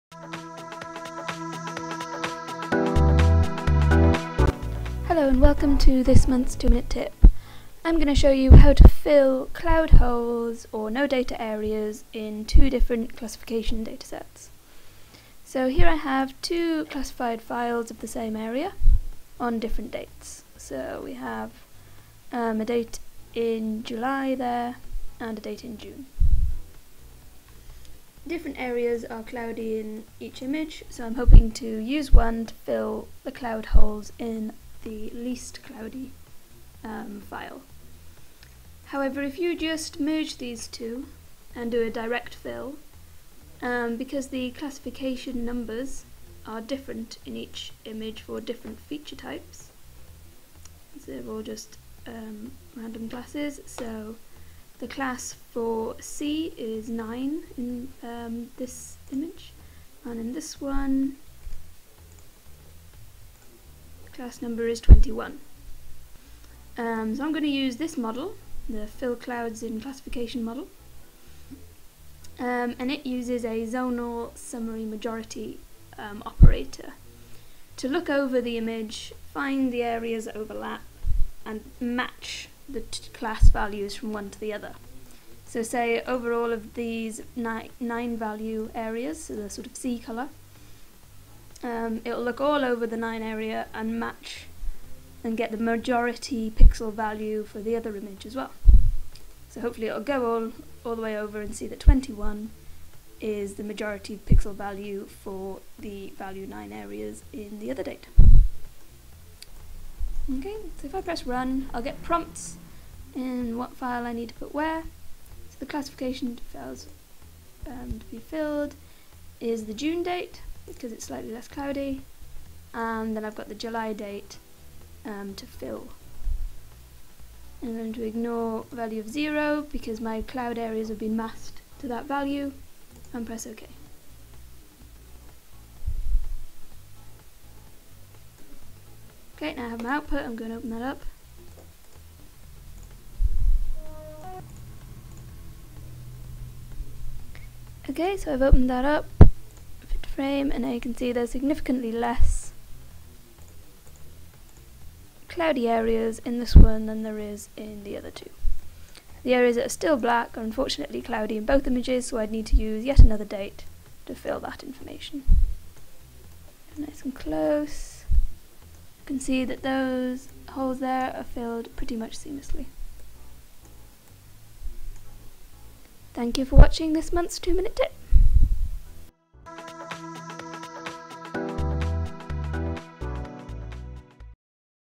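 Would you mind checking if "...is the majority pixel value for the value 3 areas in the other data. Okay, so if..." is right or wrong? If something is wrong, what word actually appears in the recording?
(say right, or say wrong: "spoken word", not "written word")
wrong: "9", not "3".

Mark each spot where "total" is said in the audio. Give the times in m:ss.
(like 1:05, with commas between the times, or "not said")
not said.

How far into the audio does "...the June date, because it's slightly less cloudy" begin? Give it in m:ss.
1:59.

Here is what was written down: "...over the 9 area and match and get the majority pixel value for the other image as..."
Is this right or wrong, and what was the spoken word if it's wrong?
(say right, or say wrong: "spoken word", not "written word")
right.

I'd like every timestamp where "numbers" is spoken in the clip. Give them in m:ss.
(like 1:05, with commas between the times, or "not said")
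0:45, 1:04.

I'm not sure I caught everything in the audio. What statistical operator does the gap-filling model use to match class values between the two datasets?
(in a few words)
zonal summary majority.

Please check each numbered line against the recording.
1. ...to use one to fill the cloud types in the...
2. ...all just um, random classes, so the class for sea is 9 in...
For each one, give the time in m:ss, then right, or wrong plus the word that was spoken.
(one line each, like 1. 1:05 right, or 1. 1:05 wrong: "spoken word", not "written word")
1. 0:31 wrong: "holes", not "types"
2. 0:51 right.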